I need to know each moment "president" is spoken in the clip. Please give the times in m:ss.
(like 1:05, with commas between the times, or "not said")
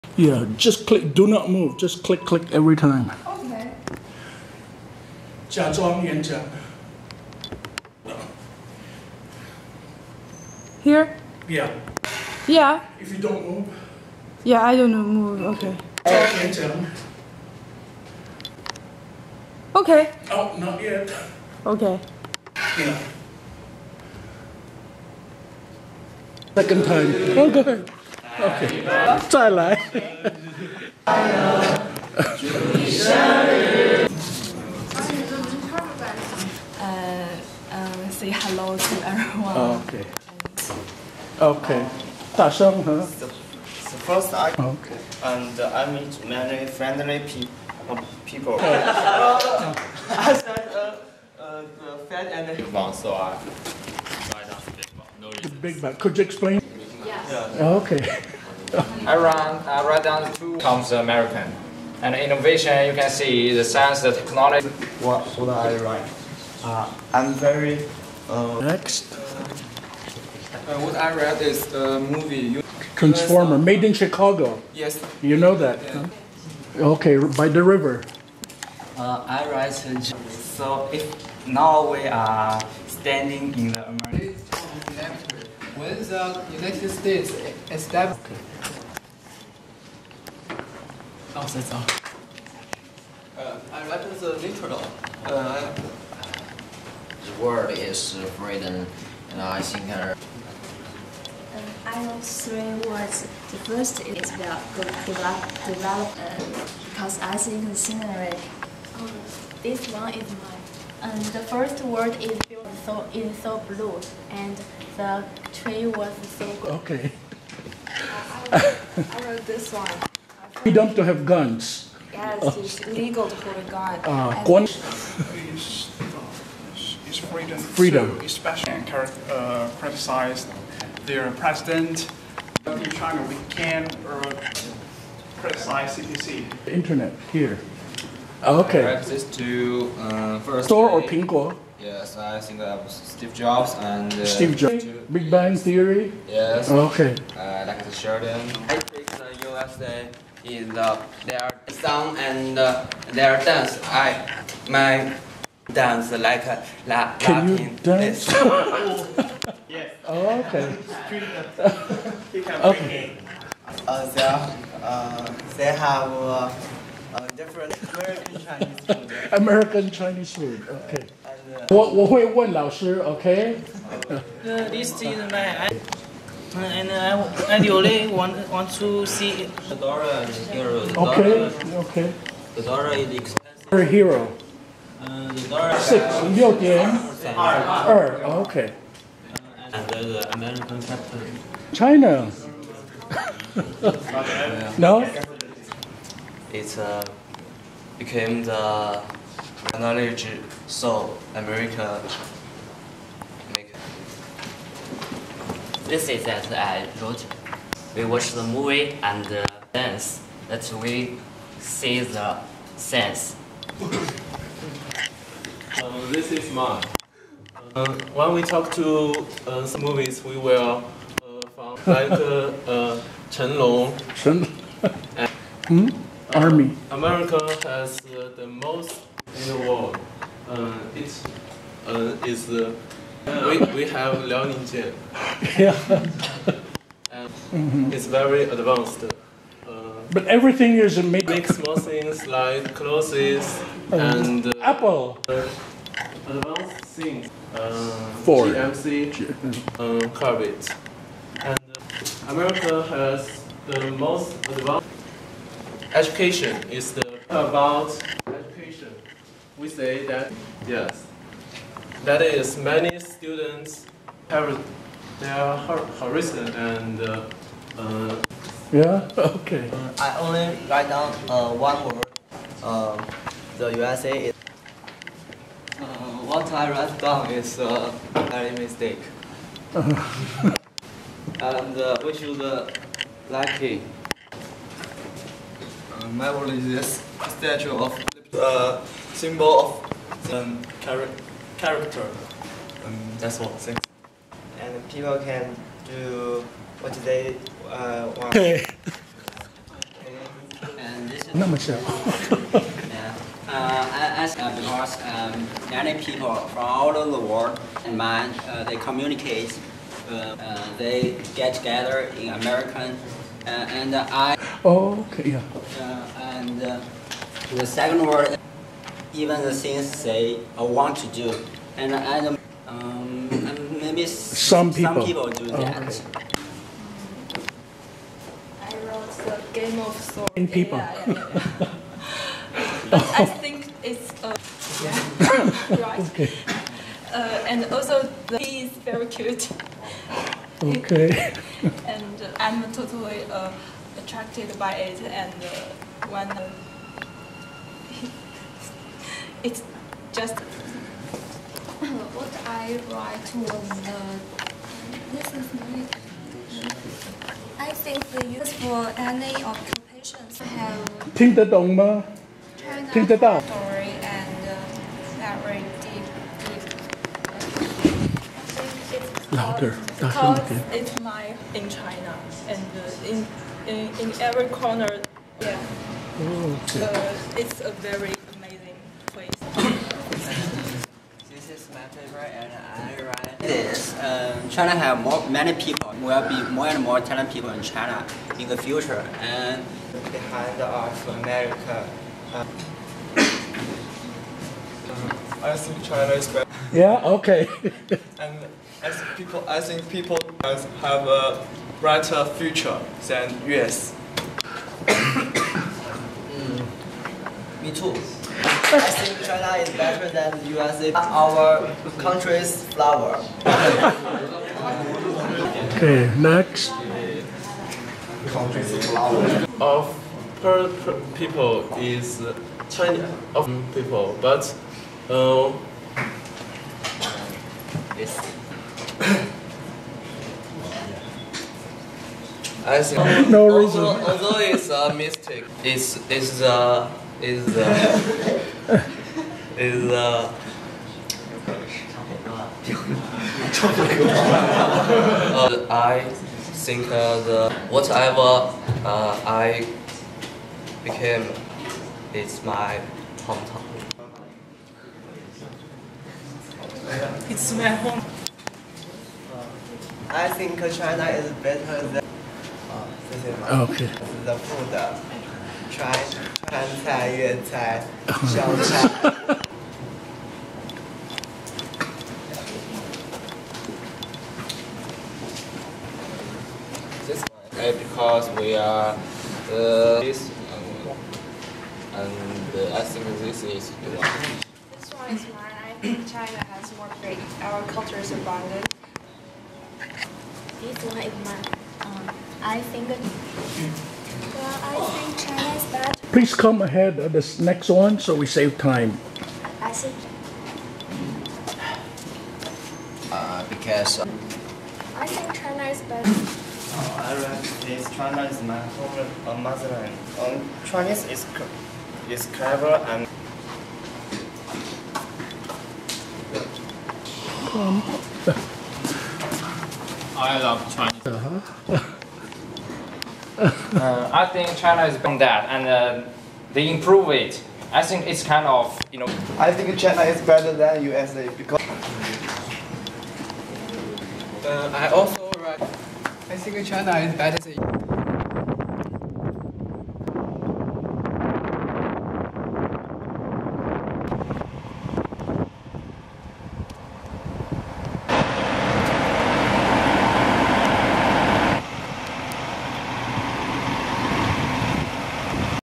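2:11.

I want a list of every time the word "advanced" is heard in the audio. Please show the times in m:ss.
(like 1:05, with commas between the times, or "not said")
3:58, 4:06, 4:14.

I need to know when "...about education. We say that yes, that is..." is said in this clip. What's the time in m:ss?
4:17.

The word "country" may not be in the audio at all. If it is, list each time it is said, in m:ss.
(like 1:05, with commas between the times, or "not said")
6:51, 6:58.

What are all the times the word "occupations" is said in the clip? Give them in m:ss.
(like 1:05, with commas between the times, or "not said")
5:59.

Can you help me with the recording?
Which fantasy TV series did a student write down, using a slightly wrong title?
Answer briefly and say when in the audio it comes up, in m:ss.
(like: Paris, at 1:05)
Game of Swords, at 5:29.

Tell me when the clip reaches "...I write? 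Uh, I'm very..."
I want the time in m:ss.
1:05.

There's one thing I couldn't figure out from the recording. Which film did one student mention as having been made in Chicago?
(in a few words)
Transformer.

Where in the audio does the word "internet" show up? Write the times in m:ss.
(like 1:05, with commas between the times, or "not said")
2:16.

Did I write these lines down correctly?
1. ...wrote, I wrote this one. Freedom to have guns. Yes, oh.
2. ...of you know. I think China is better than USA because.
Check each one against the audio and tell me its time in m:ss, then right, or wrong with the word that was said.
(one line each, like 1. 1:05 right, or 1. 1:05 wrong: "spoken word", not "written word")
1. 1:58 right
2. 8:48 right.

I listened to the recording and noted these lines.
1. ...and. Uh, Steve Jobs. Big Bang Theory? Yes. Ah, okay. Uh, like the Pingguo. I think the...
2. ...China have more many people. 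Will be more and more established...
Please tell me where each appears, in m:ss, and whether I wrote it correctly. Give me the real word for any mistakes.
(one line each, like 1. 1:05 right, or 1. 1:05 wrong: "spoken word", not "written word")
1. 2:23 wrong: "Sheridan", not "Pingguo"
2. 6:24 wrong: "talented", not "established".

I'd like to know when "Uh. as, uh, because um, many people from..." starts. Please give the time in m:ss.
5:03.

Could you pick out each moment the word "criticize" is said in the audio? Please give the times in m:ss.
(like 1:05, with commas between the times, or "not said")
2:09, 2:15.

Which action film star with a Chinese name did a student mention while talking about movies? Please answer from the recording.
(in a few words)
Chen Long.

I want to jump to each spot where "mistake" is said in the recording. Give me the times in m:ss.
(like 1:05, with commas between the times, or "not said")
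4:38, 7:14.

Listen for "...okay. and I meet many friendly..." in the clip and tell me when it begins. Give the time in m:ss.
0:44.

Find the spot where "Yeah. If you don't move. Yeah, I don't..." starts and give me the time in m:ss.
0:12.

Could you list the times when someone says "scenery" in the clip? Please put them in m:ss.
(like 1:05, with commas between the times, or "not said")
1:47.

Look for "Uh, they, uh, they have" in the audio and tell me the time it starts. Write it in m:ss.
2:43.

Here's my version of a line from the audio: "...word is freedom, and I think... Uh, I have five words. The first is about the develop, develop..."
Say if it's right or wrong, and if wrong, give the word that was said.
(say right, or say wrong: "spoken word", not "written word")
wrong: "three", not "five".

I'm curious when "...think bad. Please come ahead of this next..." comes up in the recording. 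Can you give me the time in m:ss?
8:14.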